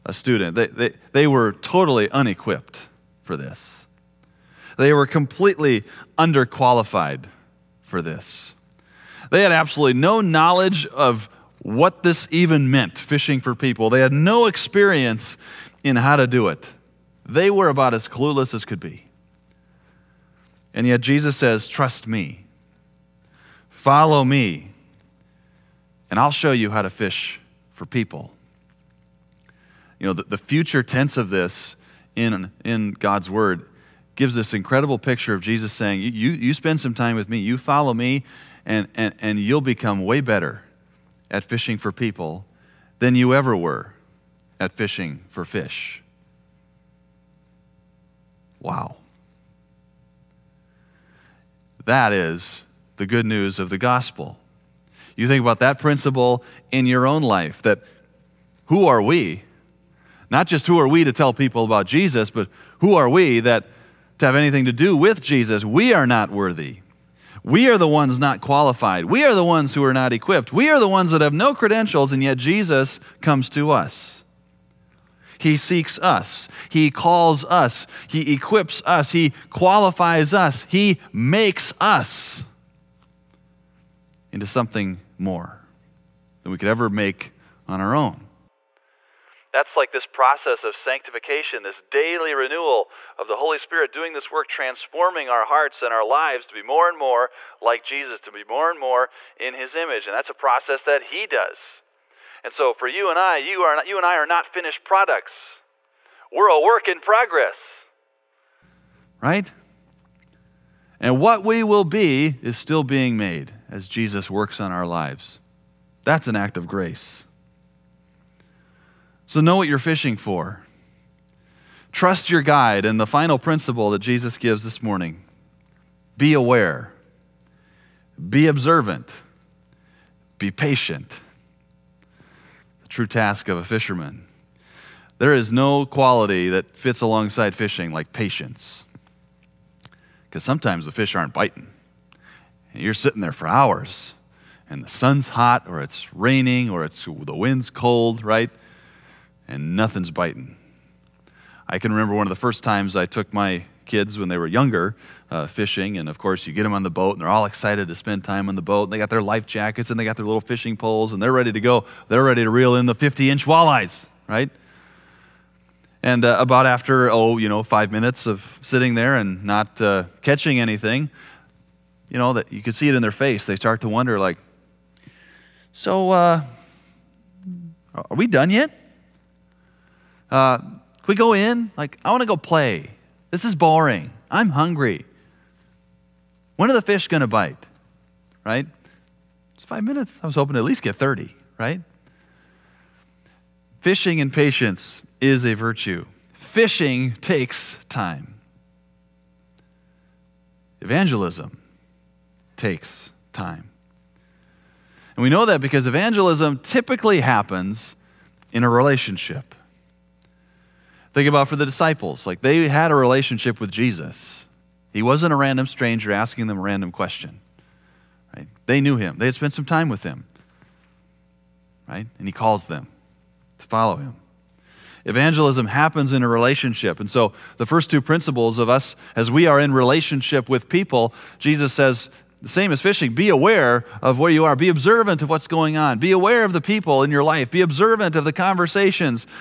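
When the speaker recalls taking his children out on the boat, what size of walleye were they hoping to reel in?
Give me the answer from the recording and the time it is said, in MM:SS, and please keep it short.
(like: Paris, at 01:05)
50 inch, at 02:42.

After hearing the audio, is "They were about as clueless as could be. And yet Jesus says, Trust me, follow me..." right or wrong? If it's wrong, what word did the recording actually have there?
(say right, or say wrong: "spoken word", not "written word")
right.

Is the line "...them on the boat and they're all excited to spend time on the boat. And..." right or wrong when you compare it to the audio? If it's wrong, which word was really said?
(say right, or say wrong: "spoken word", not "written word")
right.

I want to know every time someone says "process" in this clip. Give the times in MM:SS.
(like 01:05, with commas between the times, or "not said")
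01:30, 01:40.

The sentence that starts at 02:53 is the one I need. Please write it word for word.
They start to wonder, like, so uh, are we done yet?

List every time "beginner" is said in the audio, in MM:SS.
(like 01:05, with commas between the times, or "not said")
not said.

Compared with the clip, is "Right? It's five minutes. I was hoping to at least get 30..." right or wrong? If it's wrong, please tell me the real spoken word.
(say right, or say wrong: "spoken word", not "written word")
right.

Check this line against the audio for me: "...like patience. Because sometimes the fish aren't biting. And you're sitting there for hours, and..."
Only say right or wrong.
right.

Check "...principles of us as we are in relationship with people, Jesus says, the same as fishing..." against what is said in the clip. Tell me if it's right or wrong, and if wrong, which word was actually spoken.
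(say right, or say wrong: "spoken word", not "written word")
right.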